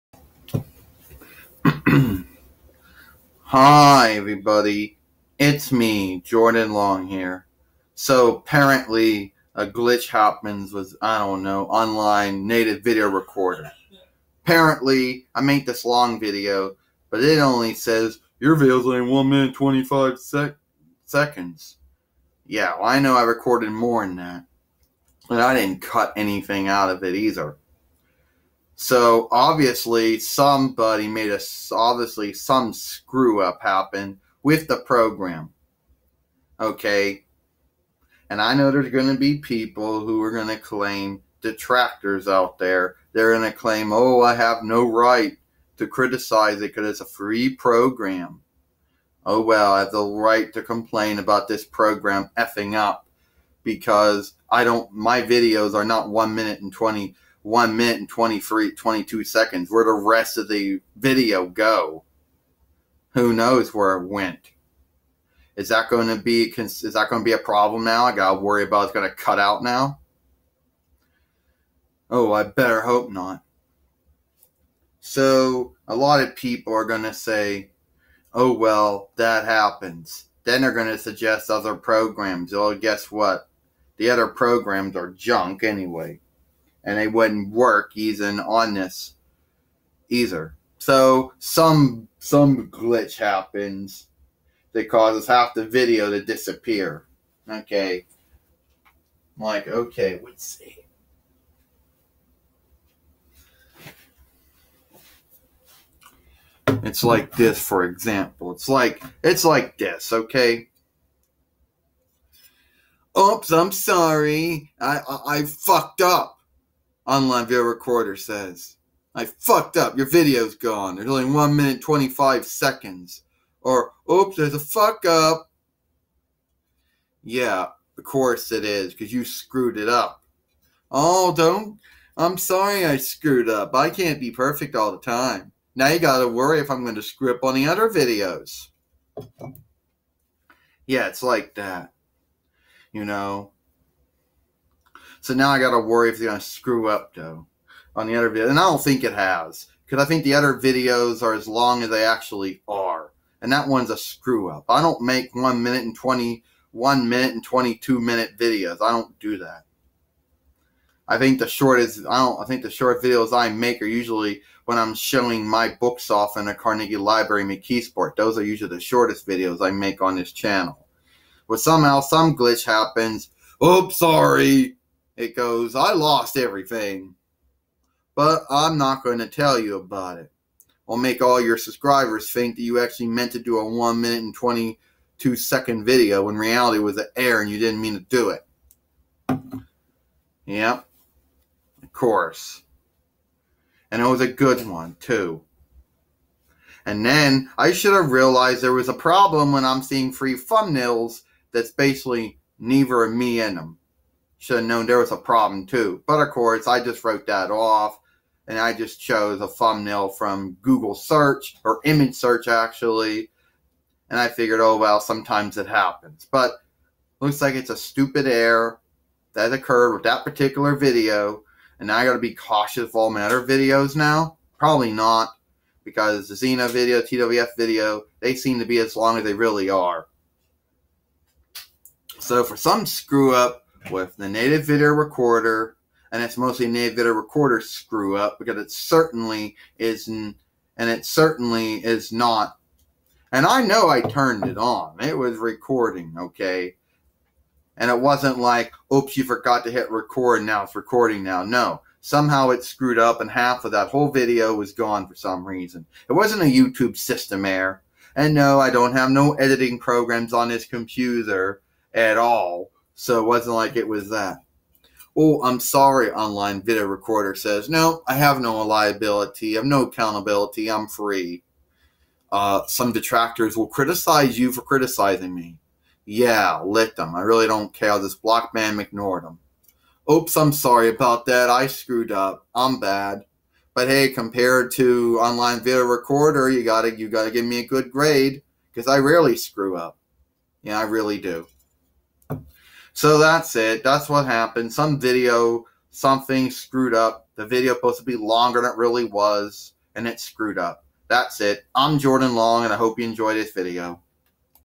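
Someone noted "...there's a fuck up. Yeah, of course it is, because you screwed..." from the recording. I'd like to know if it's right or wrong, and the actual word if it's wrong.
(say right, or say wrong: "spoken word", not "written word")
right.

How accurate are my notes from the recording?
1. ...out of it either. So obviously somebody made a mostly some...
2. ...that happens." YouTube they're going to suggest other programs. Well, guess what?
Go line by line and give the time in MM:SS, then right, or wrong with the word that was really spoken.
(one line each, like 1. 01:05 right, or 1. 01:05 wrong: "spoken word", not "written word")
1. 00:26 wrong: "obviously", not "mostly"
2. 01:19 wrong: "Then", not "YouTube".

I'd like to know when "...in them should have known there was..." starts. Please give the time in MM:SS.
03:23.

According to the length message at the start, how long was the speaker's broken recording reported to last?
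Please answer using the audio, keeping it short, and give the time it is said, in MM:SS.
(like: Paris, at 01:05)
1 minute 25 seconds, at 00:19.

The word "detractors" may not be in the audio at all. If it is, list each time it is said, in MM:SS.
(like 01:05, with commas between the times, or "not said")
00:41, 04:32.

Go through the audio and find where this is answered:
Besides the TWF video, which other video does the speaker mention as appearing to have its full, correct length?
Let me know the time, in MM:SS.
03:46.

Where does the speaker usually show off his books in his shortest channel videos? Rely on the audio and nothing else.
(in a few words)
Carnegie Library McKeesport.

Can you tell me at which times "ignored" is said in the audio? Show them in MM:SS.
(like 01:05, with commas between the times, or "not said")
04:38.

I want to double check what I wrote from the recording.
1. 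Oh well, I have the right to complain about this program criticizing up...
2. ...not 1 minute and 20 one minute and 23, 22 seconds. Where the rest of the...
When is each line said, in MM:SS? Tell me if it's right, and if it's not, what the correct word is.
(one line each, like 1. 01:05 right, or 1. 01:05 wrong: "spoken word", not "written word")
1. 00:49 wrong: "effing", not "criticizing"
2. 00:55 right.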